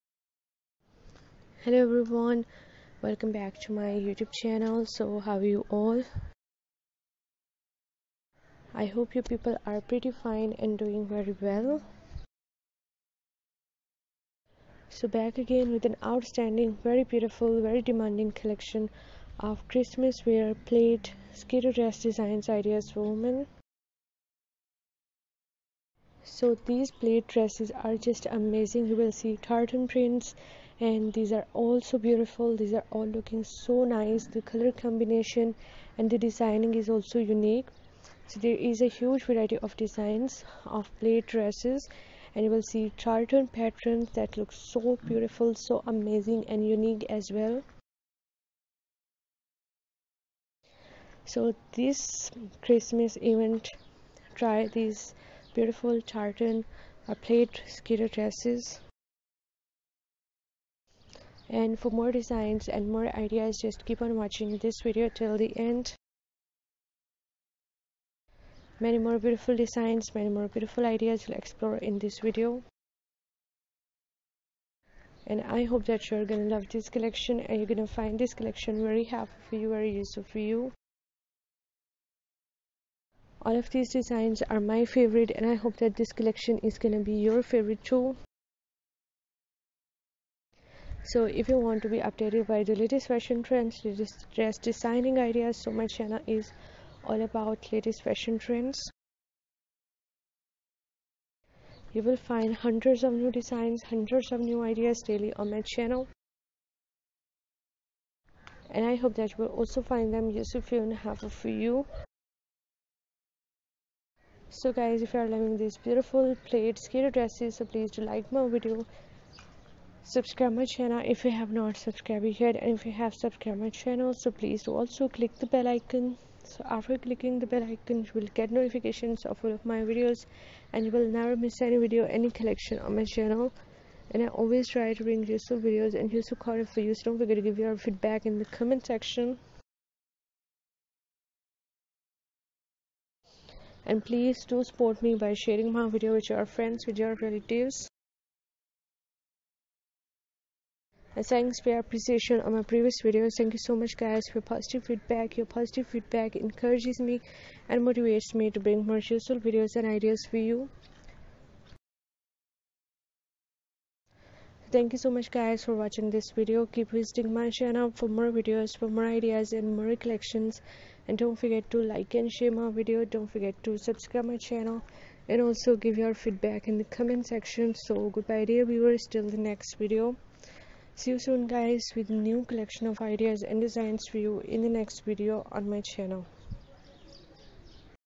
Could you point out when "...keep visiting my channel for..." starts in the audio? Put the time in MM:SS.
02:46.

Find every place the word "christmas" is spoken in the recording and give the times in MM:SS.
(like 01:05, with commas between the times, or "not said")
00:19, 00:52.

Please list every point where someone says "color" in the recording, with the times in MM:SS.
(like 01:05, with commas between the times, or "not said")
00:34.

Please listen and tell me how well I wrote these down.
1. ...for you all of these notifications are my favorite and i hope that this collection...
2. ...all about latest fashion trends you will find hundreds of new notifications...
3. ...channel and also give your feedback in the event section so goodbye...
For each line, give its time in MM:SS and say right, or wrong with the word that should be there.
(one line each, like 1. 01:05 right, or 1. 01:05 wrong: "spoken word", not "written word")
1. 01:20 wrong: "designs", not "notifications"
2. 01:37 wrong: "designs", not "notifications"
3. 02:54 wrong: "comment", not "event".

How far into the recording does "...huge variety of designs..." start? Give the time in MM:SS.
00:38.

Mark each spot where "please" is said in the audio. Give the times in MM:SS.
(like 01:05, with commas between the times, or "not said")
01:57, 02:04, 02:24.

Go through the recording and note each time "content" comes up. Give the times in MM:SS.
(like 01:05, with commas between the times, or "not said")
02:16.